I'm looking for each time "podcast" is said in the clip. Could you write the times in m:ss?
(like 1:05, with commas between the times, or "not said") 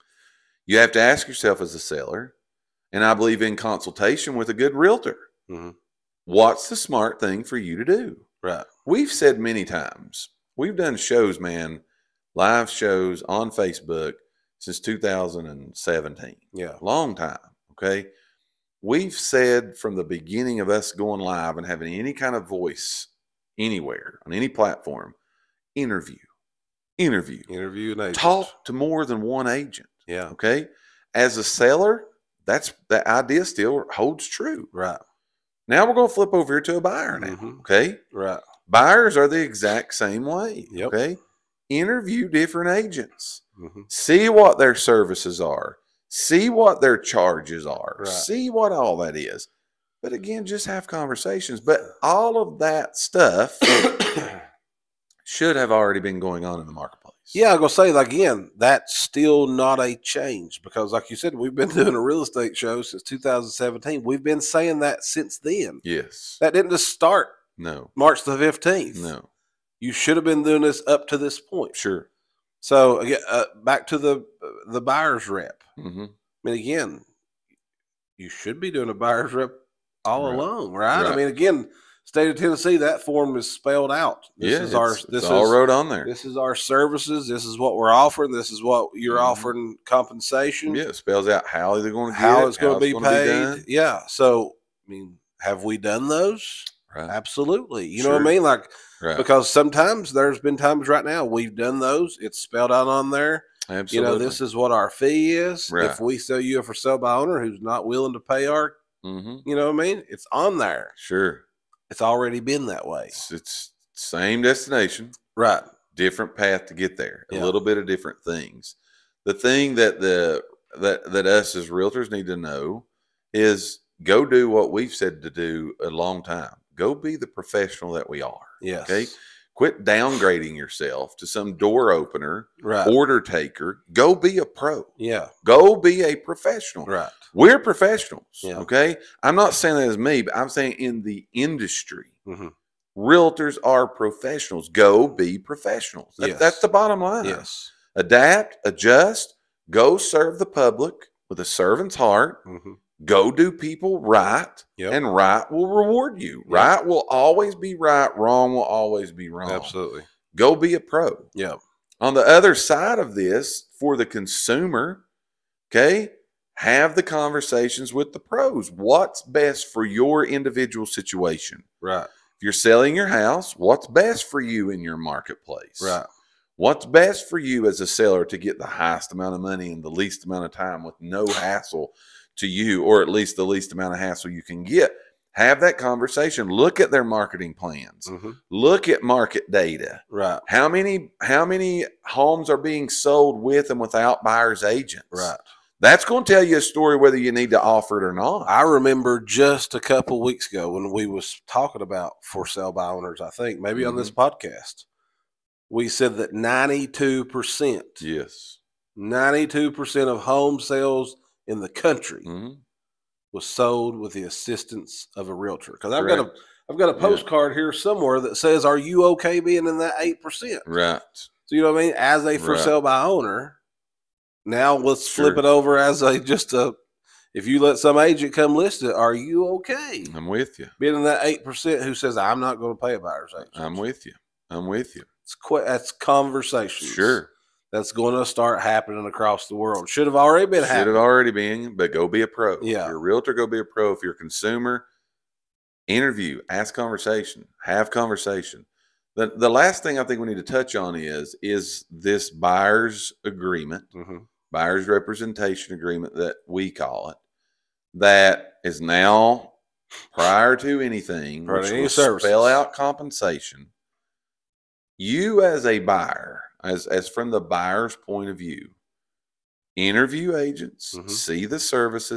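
3:24.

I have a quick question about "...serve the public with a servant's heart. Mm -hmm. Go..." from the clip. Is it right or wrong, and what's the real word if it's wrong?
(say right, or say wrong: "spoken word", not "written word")
right.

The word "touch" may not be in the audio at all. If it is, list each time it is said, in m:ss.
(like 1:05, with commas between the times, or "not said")
4:10.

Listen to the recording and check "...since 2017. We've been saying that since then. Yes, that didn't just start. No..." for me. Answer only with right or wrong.
right.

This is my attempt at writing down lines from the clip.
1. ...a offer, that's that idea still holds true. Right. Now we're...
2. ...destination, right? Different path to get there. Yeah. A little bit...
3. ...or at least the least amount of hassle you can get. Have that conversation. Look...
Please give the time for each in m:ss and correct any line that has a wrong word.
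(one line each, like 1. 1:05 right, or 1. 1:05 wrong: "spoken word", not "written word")
1. 0:31 wrong: "seller", not "offer"
2. 1:54 right
3. 3:02 right.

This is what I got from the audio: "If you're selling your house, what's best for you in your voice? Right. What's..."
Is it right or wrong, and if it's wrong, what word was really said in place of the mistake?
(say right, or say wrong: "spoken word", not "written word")
wrong: "marketplace", not "voice".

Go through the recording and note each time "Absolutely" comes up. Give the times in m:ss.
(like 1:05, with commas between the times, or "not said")
1:37, 1:43, 2:39.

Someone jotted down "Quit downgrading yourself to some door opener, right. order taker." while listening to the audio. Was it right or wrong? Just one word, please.
right.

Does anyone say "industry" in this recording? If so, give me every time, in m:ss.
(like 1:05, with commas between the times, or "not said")
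2:21.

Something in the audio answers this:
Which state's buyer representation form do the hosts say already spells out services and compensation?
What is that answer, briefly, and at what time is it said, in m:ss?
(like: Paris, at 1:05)
Tennessee, at 1:22.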